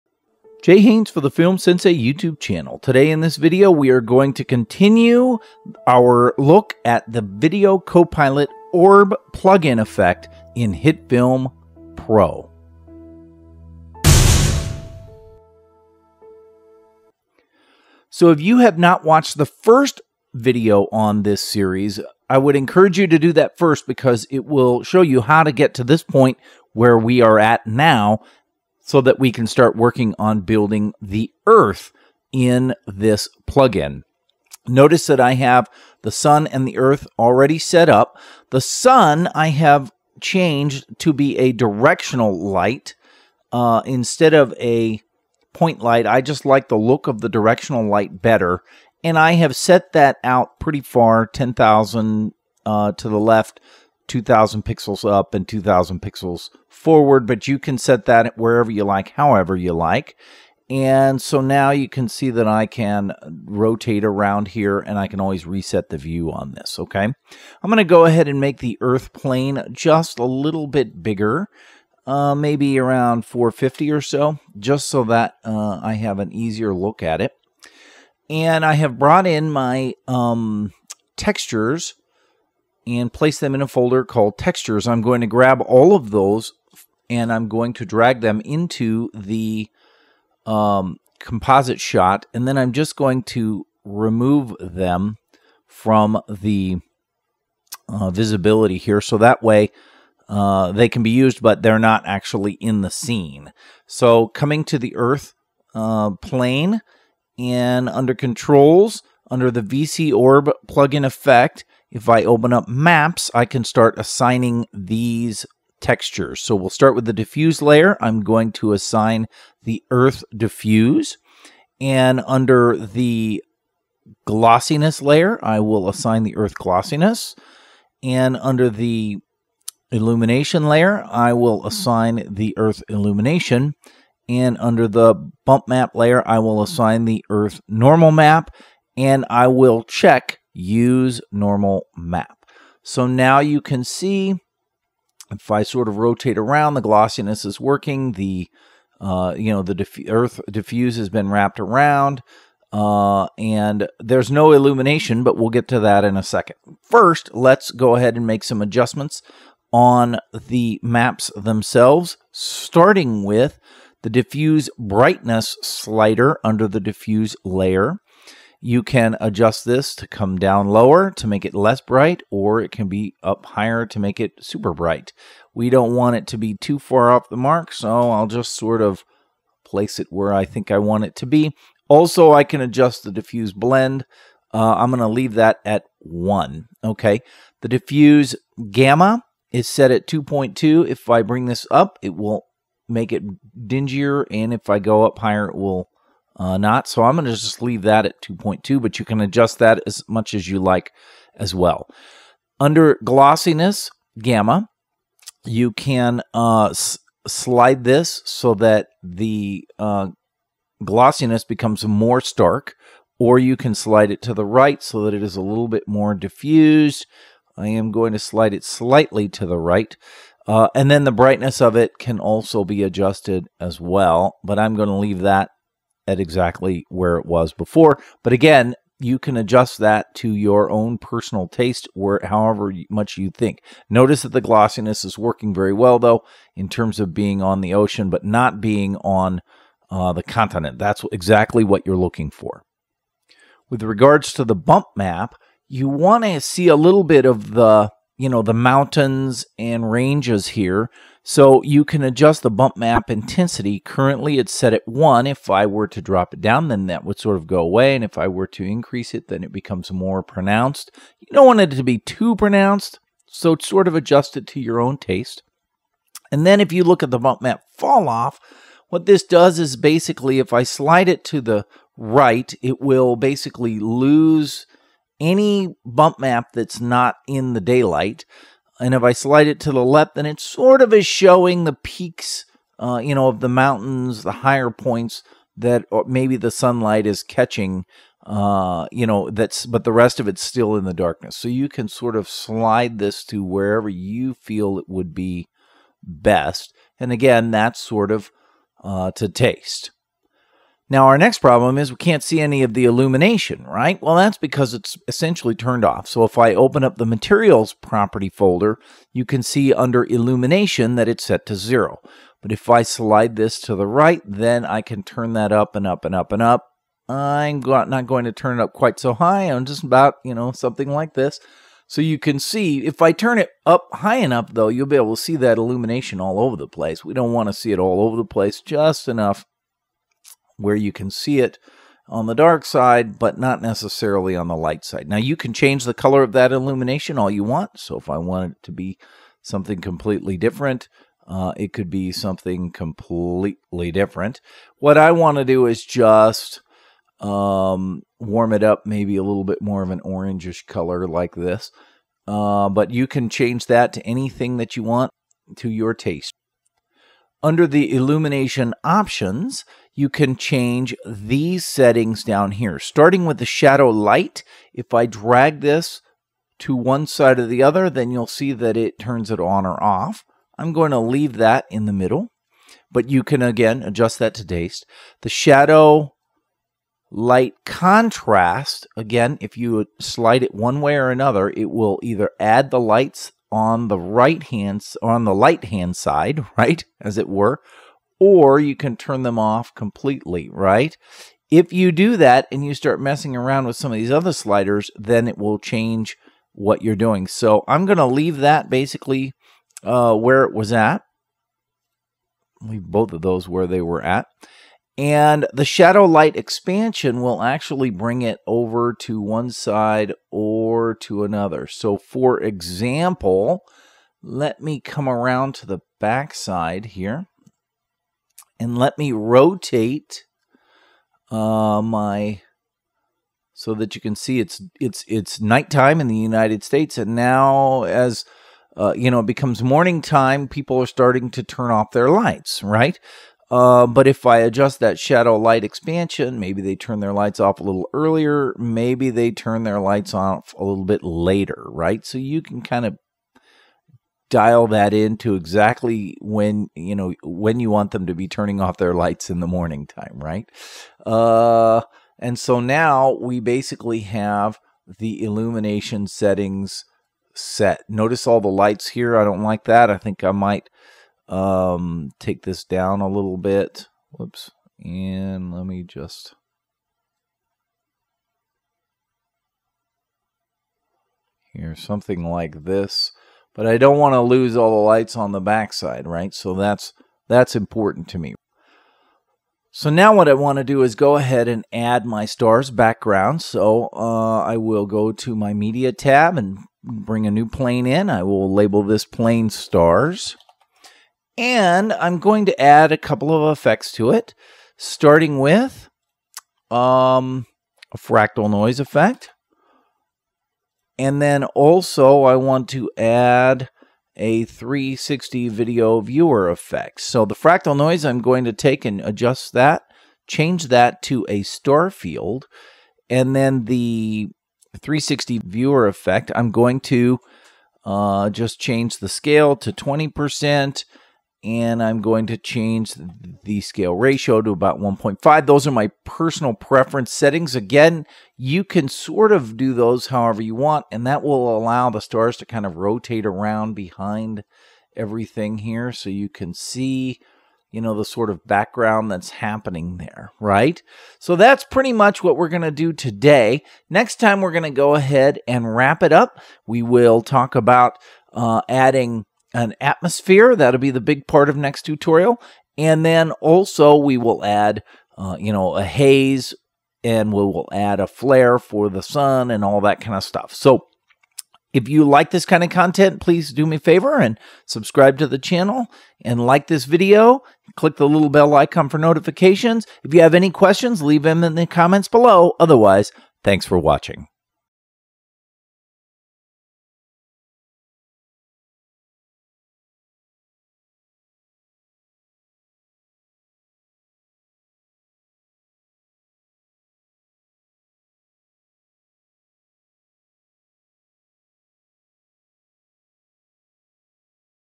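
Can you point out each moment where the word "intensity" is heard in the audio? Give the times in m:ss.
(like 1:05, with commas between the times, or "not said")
4:13.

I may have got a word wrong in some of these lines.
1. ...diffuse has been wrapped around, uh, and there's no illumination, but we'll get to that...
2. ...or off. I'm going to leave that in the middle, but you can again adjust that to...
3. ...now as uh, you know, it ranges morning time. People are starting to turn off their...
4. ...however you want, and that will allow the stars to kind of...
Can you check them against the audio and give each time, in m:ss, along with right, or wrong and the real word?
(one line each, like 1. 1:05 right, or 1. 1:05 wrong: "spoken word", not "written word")
1. 2:30 right
2. 6:09 right
3. 7:07 wrong: "becomes", not "ranges"
4. 8:50 right.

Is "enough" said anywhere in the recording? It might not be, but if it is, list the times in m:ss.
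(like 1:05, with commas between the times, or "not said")
5:24, 5:29.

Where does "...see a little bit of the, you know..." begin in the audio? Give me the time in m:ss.
4:06.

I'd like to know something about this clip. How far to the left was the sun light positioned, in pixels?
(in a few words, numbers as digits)
10,000.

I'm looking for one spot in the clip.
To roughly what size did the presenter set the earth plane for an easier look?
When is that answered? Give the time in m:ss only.
1:13.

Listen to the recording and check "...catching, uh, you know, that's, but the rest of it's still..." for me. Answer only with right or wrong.
right.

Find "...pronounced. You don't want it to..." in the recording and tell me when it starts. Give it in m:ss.
4:20.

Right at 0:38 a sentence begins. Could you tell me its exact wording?
The sun I have changed to be a directional light uh, instead of a point light.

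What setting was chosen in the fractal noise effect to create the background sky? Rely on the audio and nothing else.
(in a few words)
Star field.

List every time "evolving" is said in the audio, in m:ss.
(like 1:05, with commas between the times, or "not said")
not said.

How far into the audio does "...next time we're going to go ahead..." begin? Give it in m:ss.
9:03.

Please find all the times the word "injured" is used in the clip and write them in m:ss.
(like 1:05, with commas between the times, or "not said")
not said.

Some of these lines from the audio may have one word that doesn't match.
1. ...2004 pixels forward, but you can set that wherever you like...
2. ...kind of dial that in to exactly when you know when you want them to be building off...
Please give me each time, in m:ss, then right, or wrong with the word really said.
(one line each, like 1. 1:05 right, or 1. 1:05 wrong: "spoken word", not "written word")
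1. 0:55 wrong: "2000", not "2004"
2. 7:22 wrong: "turning", not "building".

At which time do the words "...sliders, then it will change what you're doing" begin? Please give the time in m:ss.
6:34.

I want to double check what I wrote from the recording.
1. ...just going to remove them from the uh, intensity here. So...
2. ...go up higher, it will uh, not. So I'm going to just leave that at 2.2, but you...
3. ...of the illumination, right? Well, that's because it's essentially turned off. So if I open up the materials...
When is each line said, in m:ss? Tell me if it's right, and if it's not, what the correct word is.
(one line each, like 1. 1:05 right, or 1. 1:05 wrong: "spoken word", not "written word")
1. 1:32 wrong: "visibility", not "intensity"
2. 3:14 right
3. 5:02 right.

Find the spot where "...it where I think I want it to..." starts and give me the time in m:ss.
2:59.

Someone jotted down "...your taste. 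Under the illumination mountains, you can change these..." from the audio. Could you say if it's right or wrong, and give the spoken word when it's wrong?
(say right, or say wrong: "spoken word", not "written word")
wrong: "options", not "mountains".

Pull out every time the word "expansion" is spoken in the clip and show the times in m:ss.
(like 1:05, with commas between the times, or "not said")
6:46, 7:15.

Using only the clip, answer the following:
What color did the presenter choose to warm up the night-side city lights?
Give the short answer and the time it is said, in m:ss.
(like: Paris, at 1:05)
Orangish, at 5:50.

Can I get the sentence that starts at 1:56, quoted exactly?
So we'll start with the diffuse layer.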